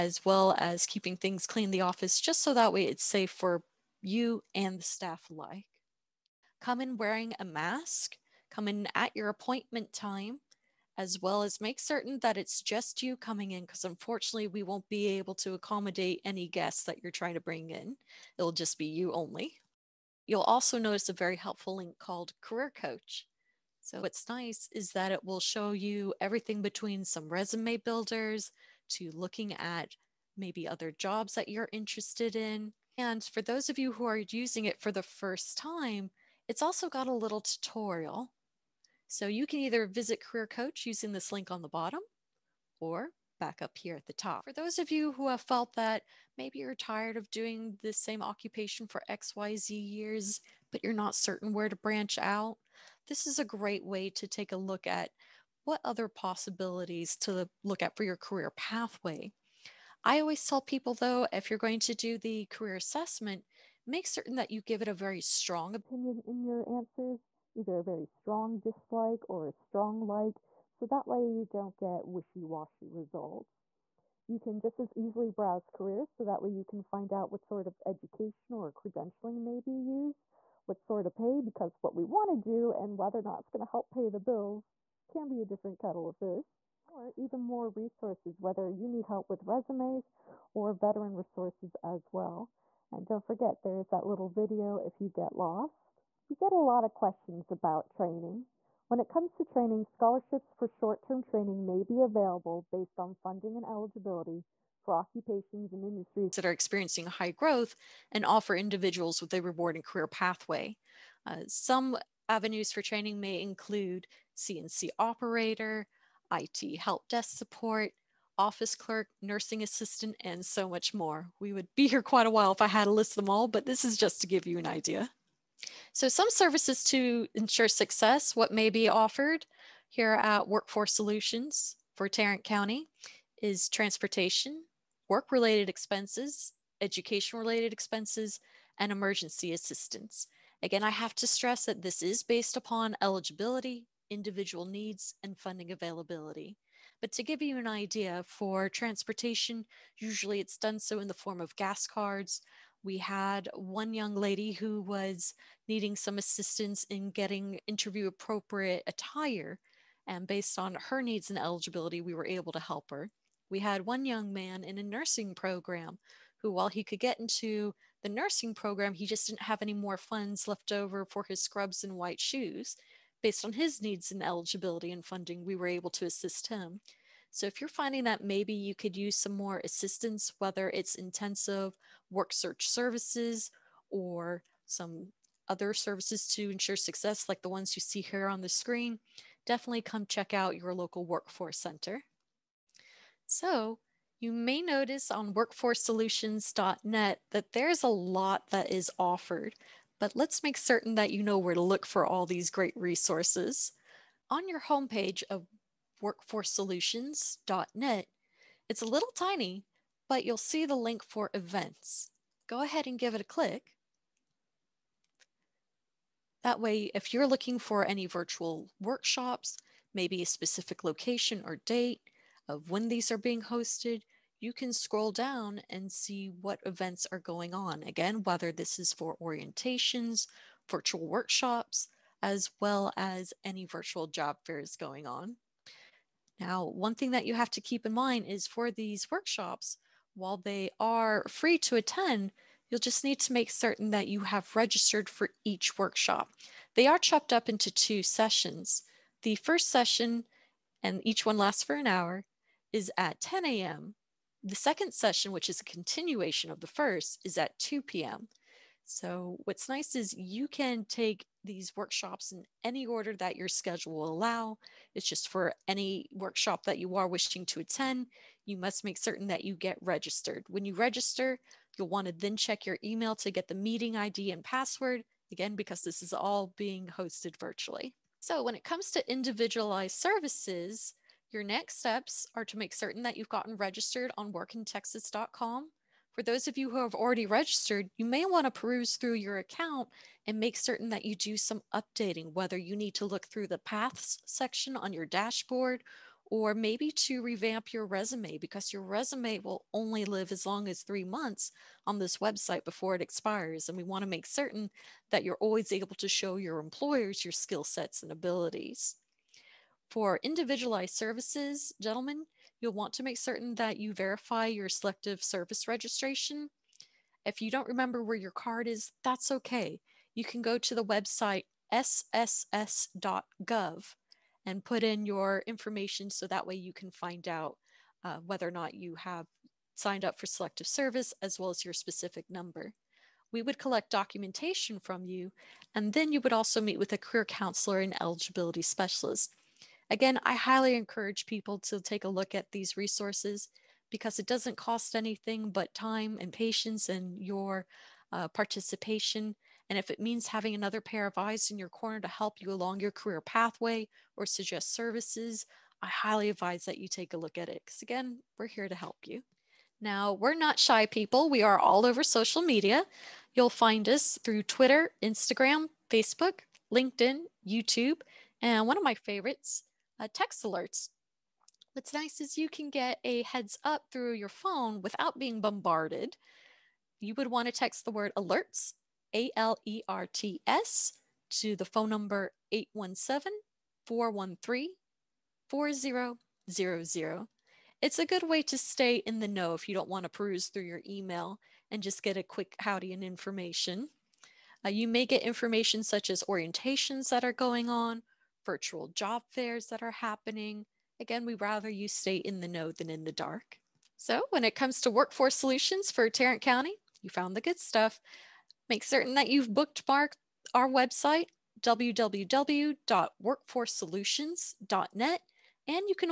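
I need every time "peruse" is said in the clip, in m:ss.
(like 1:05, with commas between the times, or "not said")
4:48, 6:30.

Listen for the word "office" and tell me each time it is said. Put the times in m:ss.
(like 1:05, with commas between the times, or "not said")
0:01, 1:58.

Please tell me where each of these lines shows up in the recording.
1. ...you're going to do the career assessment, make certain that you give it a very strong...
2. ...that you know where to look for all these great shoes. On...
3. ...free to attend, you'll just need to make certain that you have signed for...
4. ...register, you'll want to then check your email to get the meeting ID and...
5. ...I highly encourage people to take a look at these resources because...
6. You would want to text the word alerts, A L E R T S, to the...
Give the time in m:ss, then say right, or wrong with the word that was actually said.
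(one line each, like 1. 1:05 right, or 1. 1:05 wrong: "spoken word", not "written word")
1. 1:01 right
2. 3:20 wrong: "resources", not "shoes"
3. 4:01 wrong: "registered", not "signed"
4. 4:30 right
5. 5:40 right
6. 6:17 right.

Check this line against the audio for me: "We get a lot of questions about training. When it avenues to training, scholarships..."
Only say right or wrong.
wrong.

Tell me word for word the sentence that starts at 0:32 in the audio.
And for those of you who are using it for the first time, it's also got a little tutorial.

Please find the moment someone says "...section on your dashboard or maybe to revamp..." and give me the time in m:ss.
4:54.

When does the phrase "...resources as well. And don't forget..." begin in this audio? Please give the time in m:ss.
1:31.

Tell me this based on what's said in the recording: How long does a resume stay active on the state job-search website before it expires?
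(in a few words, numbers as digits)
3 months.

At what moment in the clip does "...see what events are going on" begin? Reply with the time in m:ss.
3:45.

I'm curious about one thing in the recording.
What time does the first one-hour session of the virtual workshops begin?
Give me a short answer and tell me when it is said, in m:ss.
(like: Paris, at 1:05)
10 a.m., at 4:13.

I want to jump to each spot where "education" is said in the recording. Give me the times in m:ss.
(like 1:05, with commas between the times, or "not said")
1:17, 2:16.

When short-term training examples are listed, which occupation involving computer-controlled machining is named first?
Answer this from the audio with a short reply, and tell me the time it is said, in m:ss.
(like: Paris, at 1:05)
CNC operator, at 1:54.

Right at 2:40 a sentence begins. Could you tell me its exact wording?
And based on her needs and eligibility, we were able to help her.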